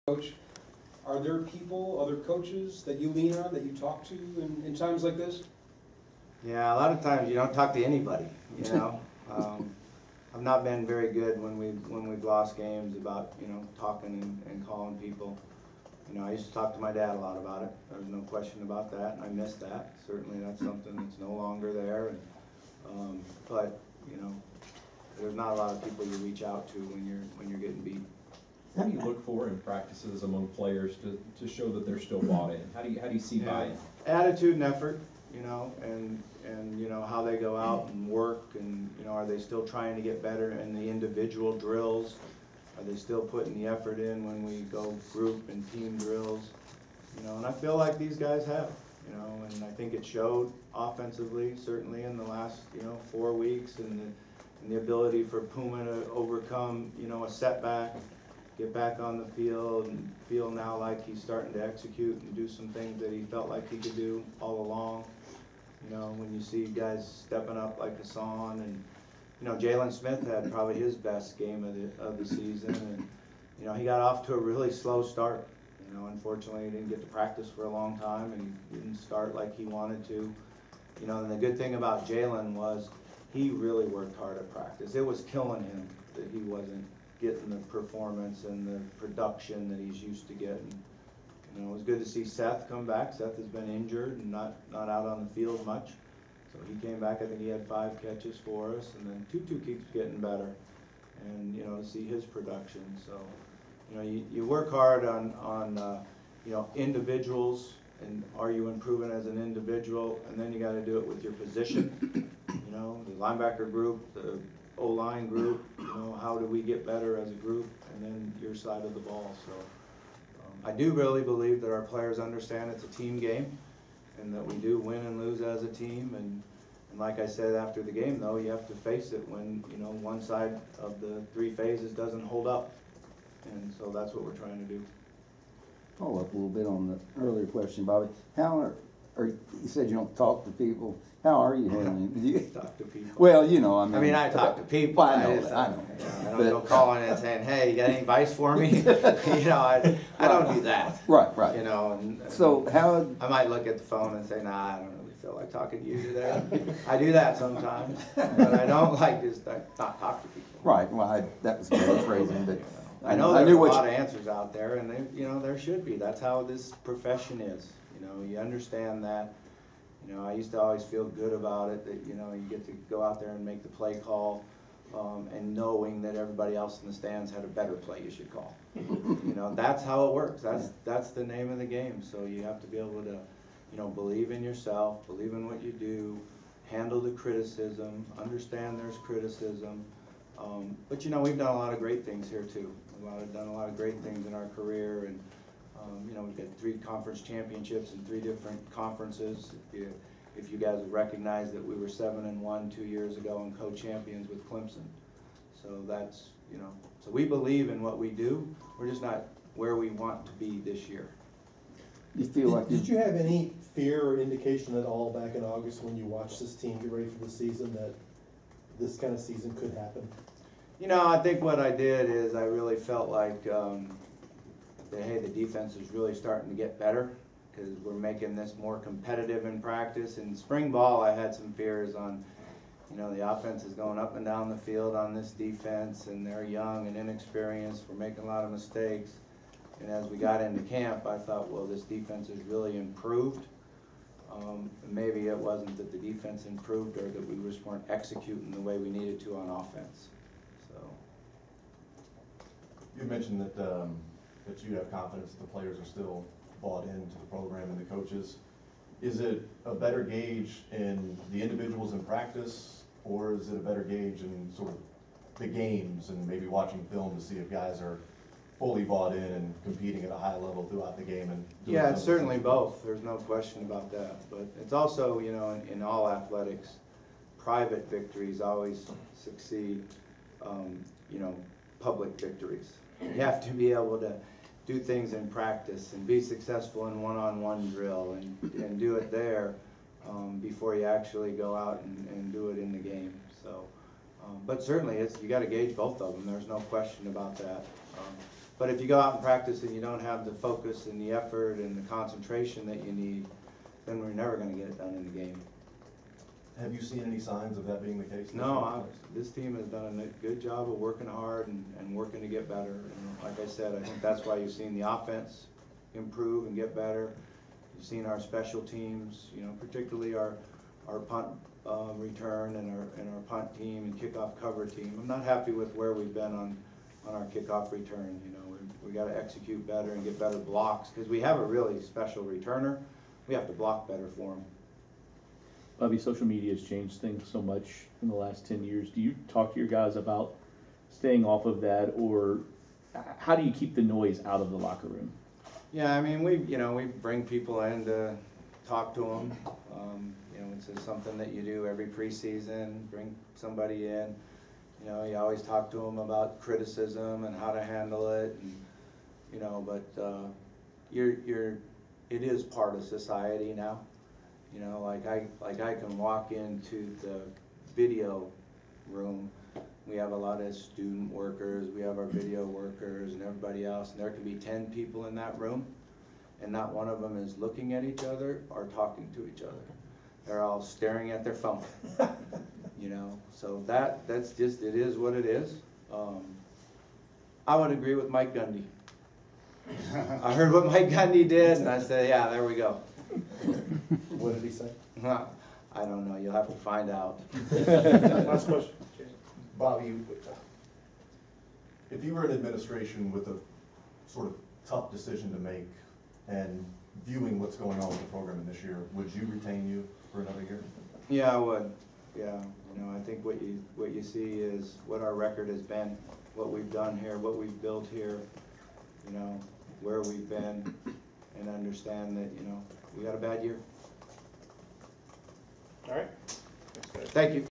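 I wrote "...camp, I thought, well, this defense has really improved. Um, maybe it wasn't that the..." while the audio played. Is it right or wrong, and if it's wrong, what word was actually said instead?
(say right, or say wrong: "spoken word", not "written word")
right.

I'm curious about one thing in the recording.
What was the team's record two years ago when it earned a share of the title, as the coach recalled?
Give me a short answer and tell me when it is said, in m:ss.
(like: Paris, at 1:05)
7-1, at 3:21.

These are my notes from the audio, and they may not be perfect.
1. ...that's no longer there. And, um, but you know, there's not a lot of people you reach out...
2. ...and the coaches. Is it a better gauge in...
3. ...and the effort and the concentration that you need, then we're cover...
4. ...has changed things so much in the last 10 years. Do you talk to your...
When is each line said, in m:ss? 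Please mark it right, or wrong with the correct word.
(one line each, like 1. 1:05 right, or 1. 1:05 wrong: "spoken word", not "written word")
1. 0:20 right
2. 4:17 right
3. 5:00 wrong: "never", not "cover"
4. 5:36 right.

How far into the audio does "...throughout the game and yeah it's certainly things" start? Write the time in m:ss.
4:30.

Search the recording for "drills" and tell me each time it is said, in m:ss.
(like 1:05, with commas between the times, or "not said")
0:41, 0:45, 4:47.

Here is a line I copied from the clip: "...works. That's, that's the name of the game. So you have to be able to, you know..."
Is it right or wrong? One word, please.
right.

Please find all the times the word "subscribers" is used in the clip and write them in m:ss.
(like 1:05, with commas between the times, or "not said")
not said.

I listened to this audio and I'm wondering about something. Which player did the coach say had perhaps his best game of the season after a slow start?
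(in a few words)
Jaylen Smith.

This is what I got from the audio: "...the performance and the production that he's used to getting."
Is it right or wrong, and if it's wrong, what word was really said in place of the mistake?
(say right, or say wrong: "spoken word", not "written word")
right.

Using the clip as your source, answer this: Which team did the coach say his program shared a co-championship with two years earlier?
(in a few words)
Clemson.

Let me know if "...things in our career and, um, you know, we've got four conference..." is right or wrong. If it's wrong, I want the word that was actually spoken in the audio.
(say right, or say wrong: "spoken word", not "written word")
wrong: "three", not "four".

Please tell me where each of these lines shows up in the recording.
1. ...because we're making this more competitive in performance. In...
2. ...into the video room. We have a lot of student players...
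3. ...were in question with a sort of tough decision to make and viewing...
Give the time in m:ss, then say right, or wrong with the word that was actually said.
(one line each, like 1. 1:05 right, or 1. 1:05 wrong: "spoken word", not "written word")
1. 3:47 wrong: "practice", not "performance"
2. 6:06 wrong: "workers", not "players"
3. 6:42 wrong: "administration", not "question".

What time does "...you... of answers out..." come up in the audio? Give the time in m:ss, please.
2:43.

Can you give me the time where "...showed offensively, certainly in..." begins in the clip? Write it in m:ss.
0:50.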